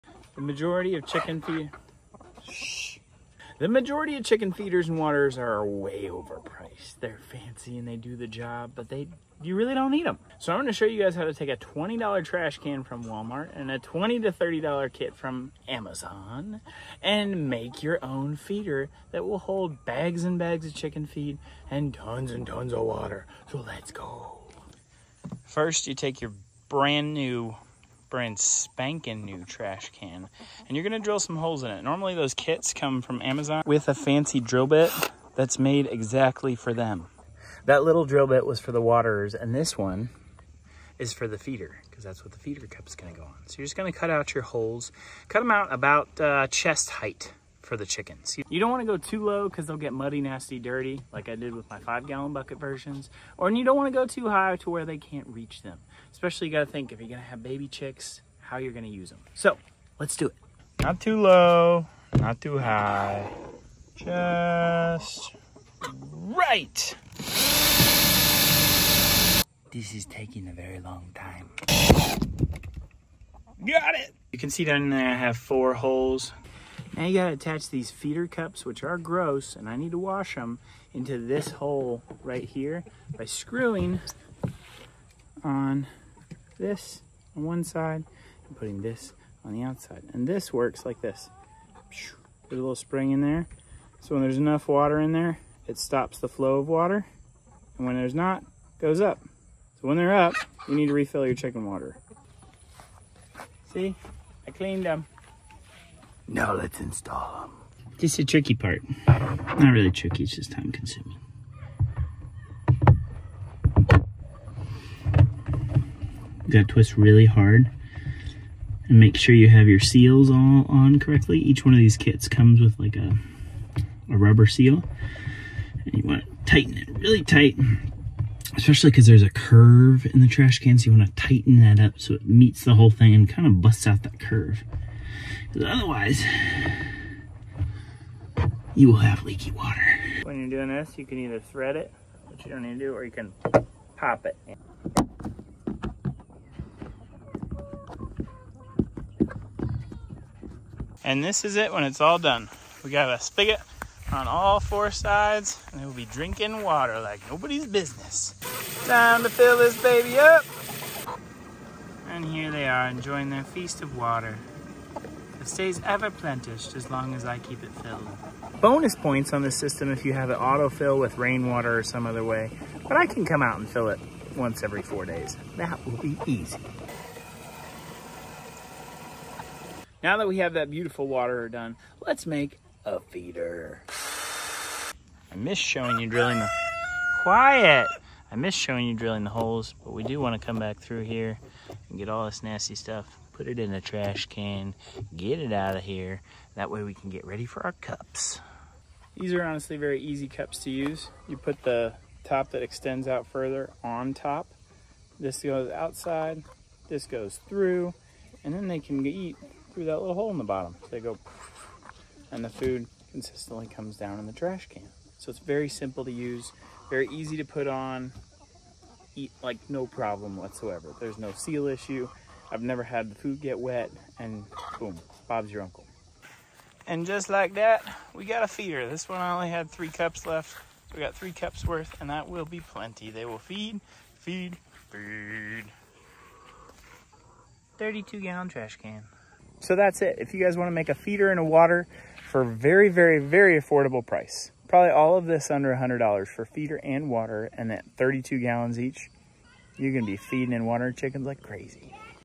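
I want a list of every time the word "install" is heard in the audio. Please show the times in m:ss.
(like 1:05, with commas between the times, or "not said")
1:46.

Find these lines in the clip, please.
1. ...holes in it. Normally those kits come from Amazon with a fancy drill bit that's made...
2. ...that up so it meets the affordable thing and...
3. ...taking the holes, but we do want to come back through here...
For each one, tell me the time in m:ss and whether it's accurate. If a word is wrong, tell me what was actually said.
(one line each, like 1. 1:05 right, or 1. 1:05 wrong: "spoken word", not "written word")
1. 0:31 right
2. 2:11 wrong: "whole", not "affordable"
3. 3:08 wrong: "drilling", not "taking".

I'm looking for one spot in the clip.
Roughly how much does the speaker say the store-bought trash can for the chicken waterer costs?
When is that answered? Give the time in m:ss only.
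0:11.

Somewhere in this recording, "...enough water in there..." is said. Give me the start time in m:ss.
1:34.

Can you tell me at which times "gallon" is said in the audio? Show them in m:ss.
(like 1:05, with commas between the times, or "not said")
0:52, 3:58, 4:08.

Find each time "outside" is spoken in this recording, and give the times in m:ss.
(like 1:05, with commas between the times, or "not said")
1:29, 3:25.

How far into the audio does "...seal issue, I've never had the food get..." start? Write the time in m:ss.
3:41.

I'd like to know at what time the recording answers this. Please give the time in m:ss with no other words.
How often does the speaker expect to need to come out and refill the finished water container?
2:54.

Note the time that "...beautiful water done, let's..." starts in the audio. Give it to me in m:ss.
3:00.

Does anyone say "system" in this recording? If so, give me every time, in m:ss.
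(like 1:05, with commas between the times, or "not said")
2:49.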